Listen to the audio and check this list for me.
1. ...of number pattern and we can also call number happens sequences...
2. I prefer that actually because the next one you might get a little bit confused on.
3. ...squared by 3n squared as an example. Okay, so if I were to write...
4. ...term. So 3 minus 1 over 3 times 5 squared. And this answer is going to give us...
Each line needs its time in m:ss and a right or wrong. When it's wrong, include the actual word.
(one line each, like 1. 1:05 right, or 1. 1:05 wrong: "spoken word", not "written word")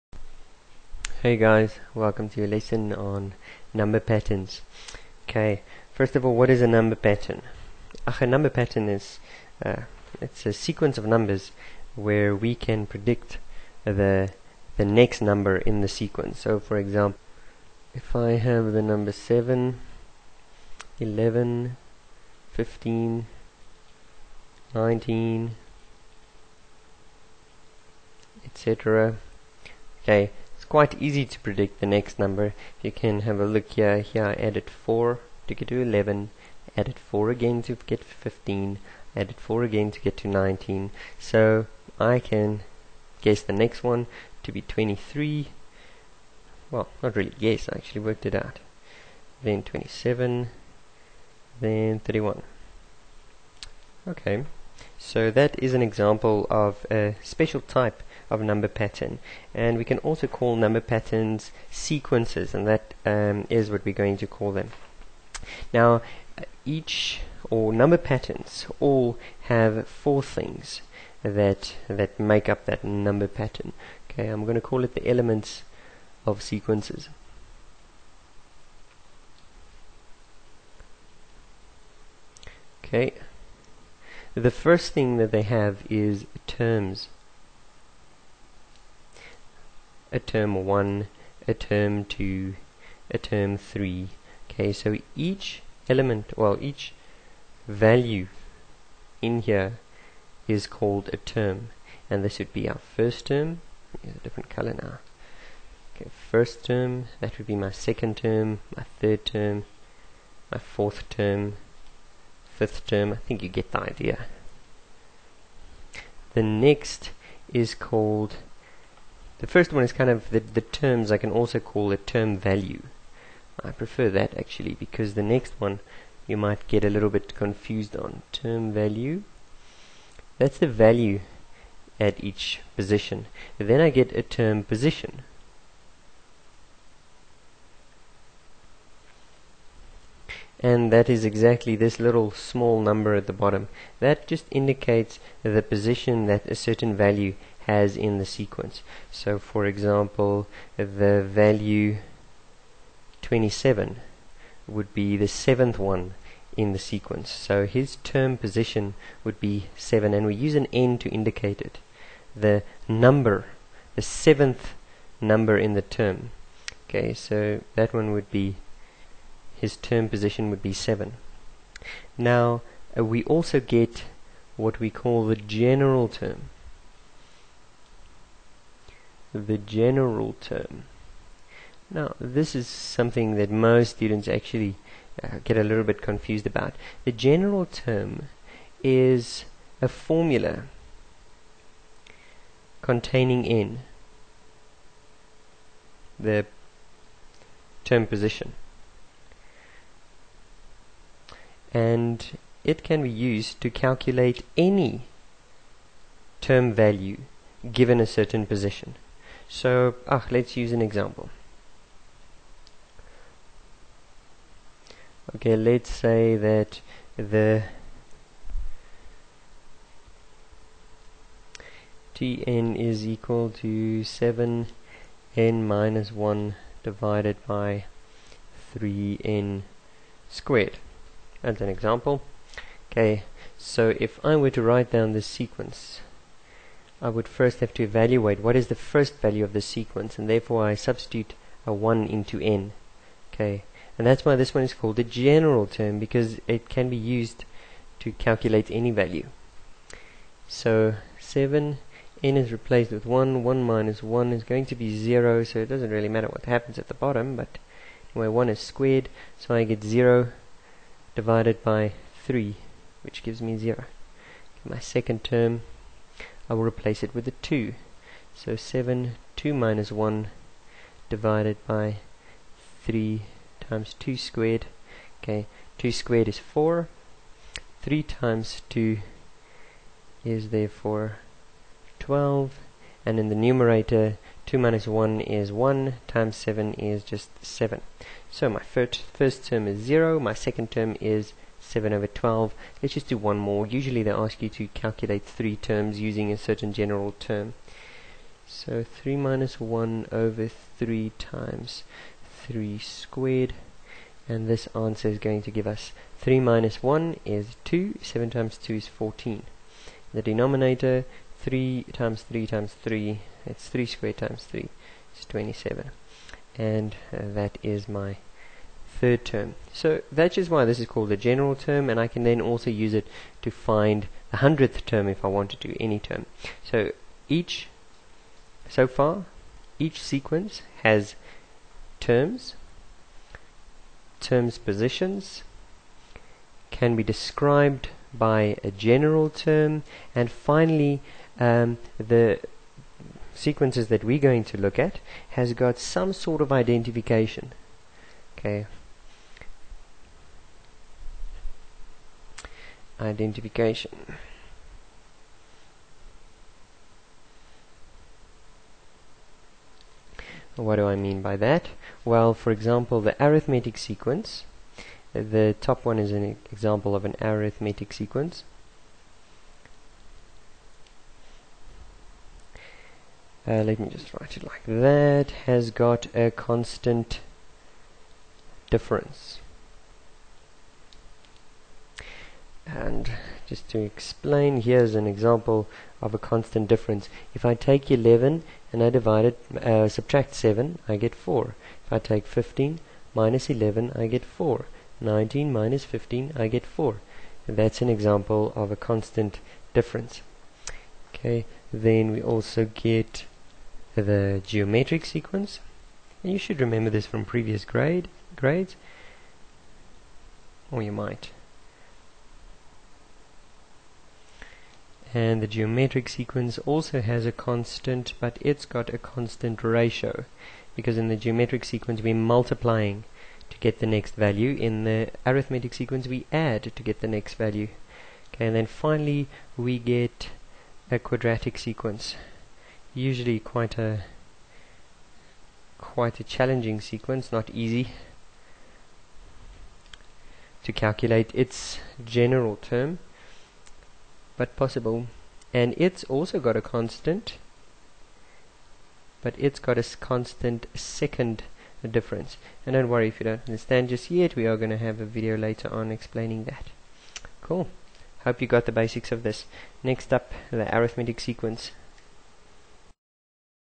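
1. 0:58 wrong: "patterns", not "happens"
2. 2:03 right
3. 3:46 wrong: "divided", not "squared"
4. 4:57 wrong: "3", not "5".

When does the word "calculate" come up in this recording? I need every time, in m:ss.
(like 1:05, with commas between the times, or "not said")
3:23, 4:08, 4:54, 7:20.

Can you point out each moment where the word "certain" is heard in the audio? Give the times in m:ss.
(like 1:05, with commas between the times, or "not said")
2:26, 3:28, 4:56.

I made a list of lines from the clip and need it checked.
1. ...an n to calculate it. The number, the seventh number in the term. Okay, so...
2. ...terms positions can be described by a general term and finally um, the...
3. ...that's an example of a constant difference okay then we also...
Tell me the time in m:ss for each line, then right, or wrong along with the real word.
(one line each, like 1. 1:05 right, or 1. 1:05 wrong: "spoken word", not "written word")
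1. 2:40 wrong: "indicate", not "calculate"
2. 5:34 right
3. 6:37 right.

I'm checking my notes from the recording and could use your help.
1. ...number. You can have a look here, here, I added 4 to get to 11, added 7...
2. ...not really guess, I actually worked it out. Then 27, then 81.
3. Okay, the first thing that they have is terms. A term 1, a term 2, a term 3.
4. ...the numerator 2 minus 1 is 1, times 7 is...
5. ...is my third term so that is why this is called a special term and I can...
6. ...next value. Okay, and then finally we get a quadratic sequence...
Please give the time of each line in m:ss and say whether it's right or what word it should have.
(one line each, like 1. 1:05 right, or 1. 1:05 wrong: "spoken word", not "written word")
1. 0:32 wrong: "4", not "7"
2. 0:47 wrong: "31", not "81"
3. 1:22 right
4. 4:43 right
5. 5:17 wrong: "general", not "special"
6. 7:07 right.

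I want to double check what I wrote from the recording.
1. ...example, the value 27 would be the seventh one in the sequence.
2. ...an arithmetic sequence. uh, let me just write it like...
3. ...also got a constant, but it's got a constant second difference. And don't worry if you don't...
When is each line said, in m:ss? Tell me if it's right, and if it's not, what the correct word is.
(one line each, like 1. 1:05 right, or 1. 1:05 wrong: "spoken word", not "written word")
1. 2:29 right
2. 6:07 right
3. 7:26 right.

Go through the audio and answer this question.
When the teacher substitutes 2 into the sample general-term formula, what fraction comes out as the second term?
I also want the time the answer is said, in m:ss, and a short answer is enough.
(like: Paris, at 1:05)
7/12, at 4:51.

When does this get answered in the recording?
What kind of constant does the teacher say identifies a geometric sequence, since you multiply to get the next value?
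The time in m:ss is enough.
6:58.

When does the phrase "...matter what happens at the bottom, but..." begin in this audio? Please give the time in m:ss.
4:16.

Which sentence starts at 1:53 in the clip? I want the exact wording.
I think you get the idea.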